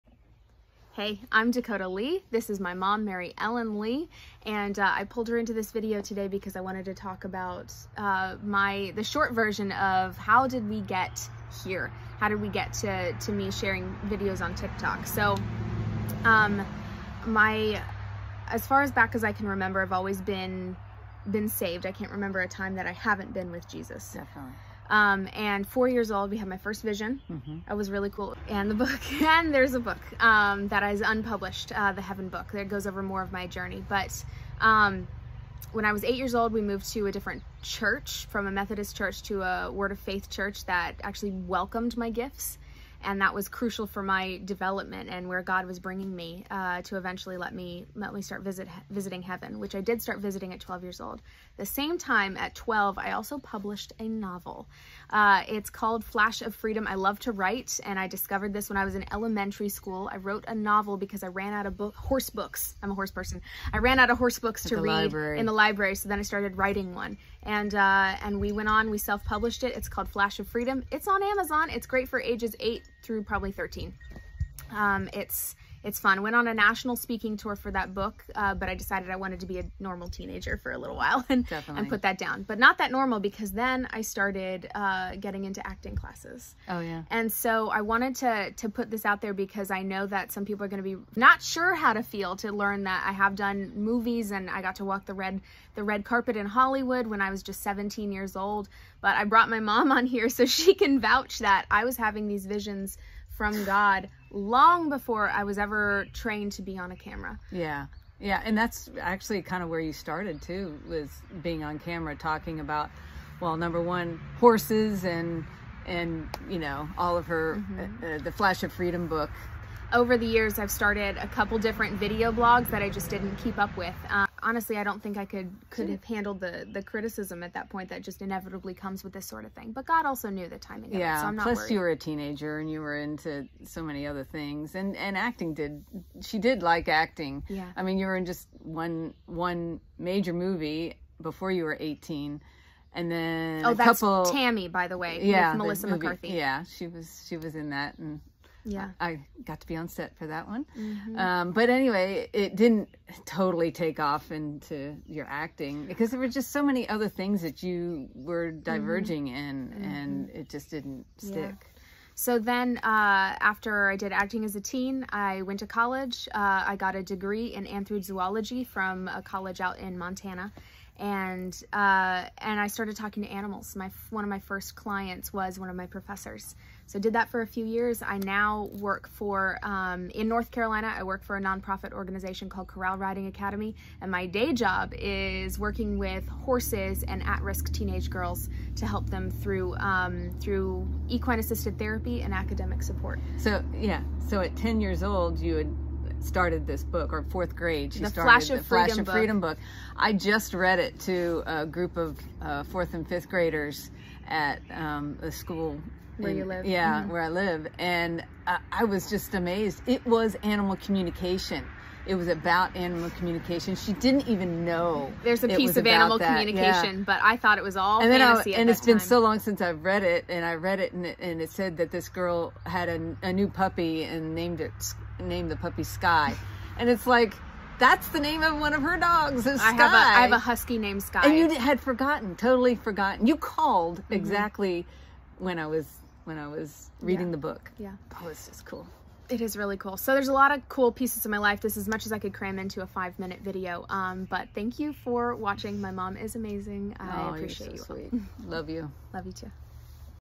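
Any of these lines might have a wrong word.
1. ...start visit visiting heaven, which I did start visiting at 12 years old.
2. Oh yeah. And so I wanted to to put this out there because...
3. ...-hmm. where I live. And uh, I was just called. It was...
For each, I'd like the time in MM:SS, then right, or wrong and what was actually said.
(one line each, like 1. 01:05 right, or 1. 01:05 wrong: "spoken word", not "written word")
1. 00:48 right
2. 01:26 right
3. 03:27 wrong: "amazed", not "called".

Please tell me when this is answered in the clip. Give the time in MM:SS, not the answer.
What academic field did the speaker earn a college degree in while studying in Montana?
02:47.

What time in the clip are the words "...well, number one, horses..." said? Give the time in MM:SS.
01:53.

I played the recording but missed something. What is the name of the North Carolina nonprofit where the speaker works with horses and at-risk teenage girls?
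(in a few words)
Corral Riding Academy.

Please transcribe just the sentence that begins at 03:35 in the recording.
There's a piece of animal that.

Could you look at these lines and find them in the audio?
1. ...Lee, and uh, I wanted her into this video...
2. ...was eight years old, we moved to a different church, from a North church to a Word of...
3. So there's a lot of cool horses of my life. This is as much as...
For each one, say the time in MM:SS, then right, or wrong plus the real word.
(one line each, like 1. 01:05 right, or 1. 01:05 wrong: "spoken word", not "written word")
1. 00:03 wrong: "pulled", not "wanted"
2. 00:35 wrong: "Methodist", not "North"
3. 03:59 wrong: "pieces", not "horses".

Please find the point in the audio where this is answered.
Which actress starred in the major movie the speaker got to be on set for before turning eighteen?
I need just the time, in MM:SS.
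02:25.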